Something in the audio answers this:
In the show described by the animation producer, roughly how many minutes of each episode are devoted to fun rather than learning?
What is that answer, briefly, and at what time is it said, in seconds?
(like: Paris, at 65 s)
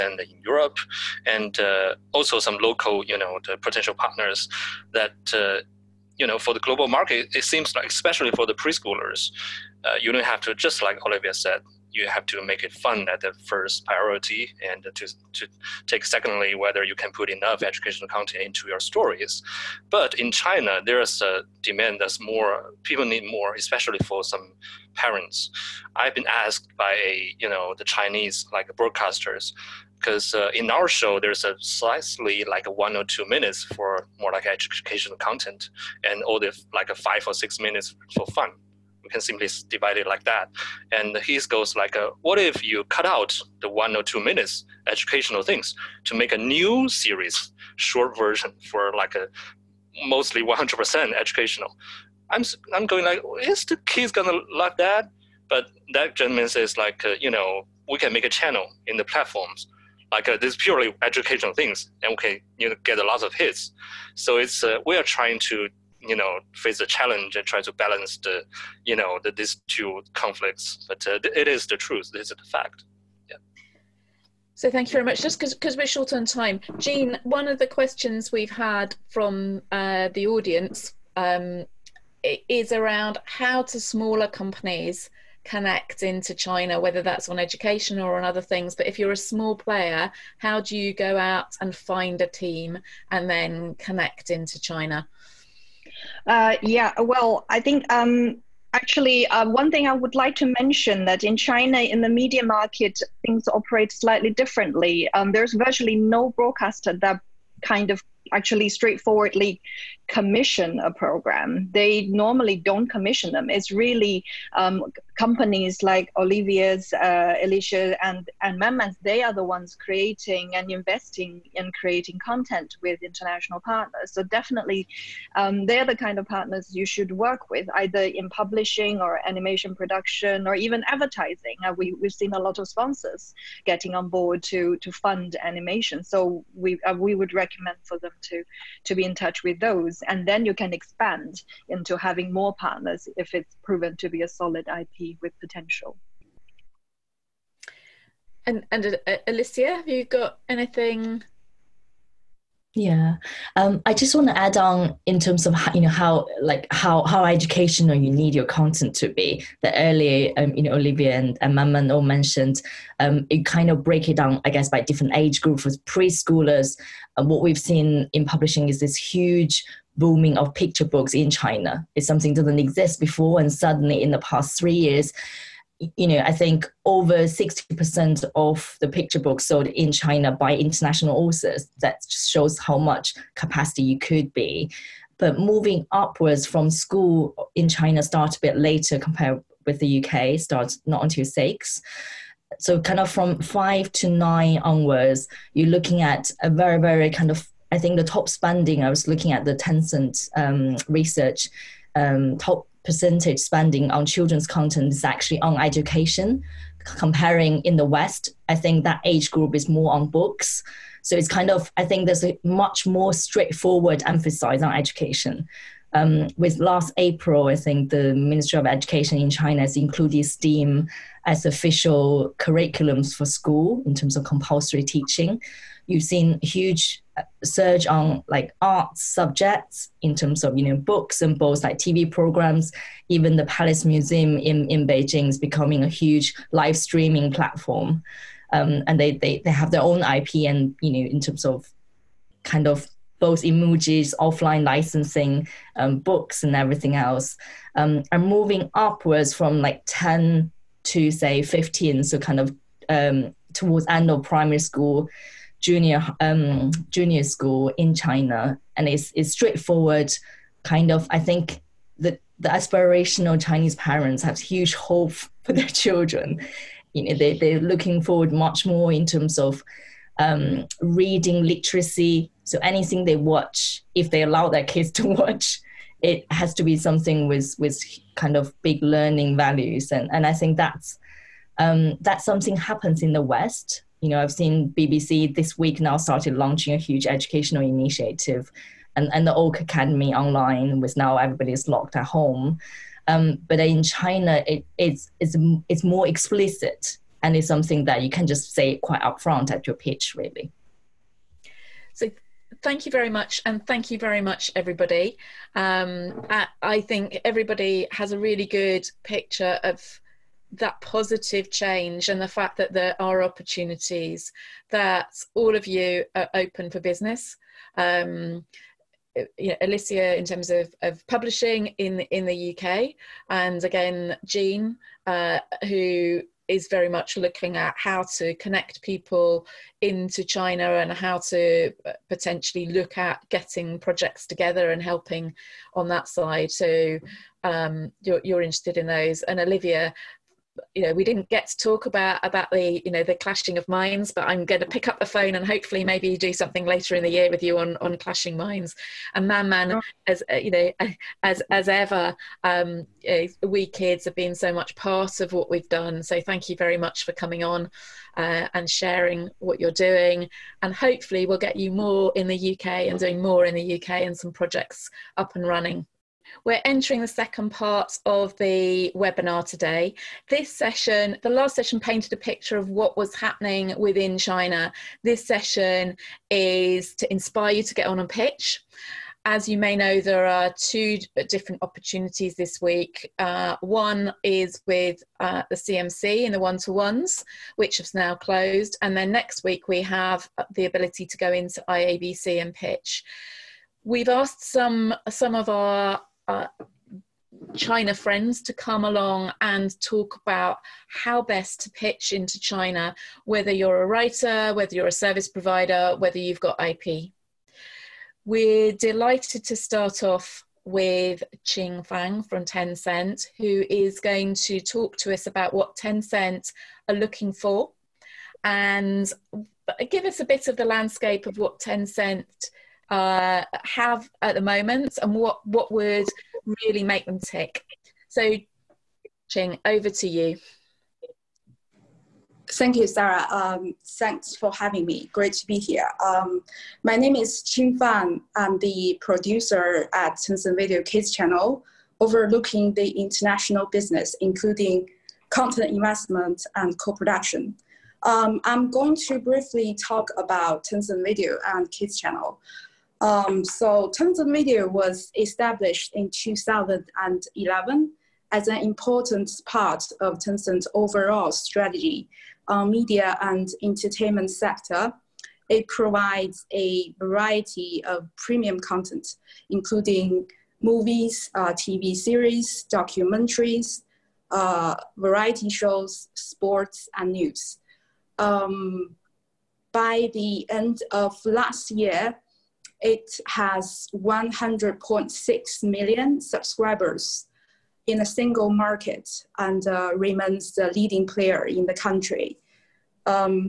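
5 or 6 minutes, at 36 s.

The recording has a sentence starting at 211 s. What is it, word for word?
So it's kind of, I think there's a much more straightforward emphasis on education.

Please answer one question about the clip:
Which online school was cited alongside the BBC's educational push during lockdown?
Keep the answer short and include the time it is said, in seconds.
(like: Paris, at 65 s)
Oak Academy, at 289 s.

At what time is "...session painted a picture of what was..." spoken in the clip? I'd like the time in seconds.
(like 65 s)
371 s.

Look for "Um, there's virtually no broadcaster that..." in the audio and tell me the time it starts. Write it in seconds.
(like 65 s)
105 s.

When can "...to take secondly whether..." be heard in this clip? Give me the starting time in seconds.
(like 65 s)
15 s.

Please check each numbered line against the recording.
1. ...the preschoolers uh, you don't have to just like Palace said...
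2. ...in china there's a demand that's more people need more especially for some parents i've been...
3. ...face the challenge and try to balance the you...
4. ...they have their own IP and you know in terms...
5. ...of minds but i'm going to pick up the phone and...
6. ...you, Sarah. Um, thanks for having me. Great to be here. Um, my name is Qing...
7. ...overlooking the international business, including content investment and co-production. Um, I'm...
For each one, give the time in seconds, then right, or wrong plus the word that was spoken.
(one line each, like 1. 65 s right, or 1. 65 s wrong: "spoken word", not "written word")
1. 8 s wrong: "Olivia", not "Palace"
2. 20 s right
3. 66 s right
4. 239 s right
5. 343 s right
6. 432 s right
7. 441 s right.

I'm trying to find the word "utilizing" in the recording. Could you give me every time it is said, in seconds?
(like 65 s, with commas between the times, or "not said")
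not said.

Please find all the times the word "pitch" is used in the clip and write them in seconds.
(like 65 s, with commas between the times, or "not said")
299 s, 378 s, 392 s, 401 s.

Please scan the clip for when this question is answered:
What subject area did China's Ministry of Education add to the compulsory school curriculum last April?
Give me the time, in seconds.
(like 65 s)
220 s.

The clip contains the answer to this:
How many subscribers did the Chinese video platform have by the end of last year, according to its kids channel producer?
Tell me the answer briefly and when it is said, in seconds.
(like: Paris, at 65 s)
100.6 million, at 483 s.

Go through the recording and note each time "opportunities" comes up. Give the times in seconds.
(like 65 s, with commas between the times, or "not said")
313 s, 381 s.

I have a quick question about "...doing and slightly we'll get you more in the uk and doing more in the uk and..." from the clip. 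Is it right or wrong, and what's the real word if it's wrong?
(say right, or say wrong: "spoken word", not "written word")
wrong: "hopefully", not "slightly".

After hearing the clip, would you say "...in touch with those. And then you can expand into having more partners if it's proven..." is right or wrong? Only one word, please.
right.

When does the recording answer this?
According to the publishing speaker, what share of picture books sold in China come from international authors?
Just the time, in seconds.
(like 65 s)
176 s.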